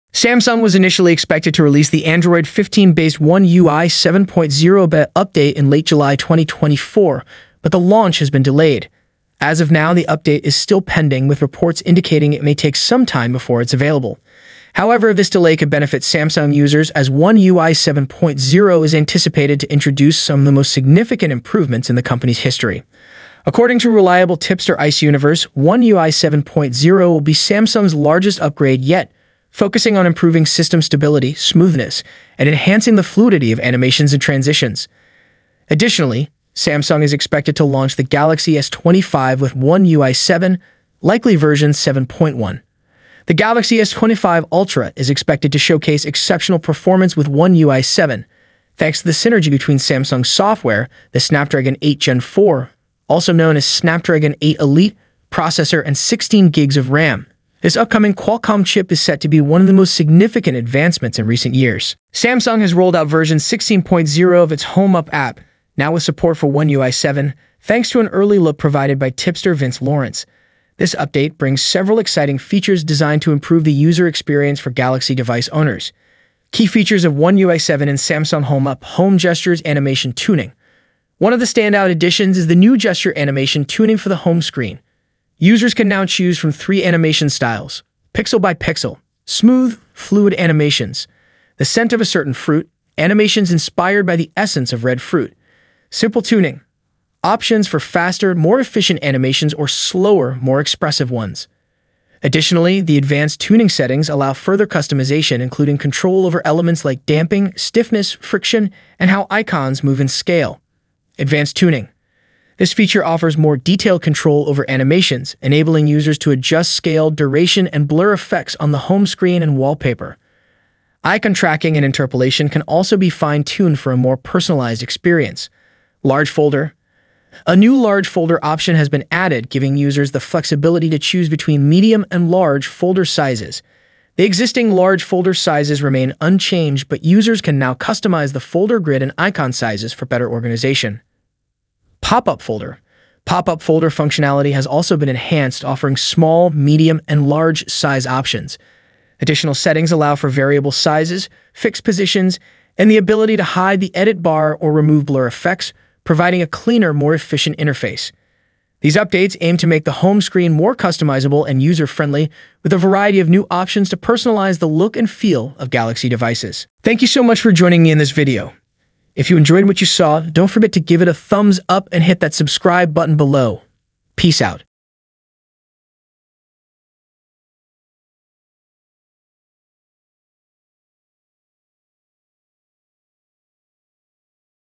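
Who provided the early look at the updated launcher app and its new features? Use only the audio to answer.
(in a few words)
Vince Lawrence.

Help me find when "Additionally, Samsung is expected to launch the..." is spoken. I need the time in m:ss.
0:35.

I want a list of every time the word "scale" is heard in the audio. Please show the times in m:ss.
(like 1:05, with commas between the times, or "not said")
1:50, 1:56.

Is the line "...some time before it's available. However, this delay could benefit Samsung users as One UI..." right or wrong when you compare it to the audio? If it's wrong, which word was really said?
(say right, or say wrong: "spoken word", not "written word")
right.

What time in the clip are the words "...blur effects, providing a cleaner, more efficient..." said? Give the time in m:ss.
2:35.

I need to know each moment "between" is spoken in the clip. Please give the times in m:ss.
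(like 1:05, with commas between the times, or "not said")
0:49, 2:11.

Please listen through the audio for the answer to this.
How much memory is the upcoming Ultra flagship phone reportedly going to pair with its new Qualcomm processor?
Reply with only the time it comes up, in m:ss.
0:55.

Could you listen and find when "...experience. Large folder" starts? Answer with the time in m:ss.
2:04.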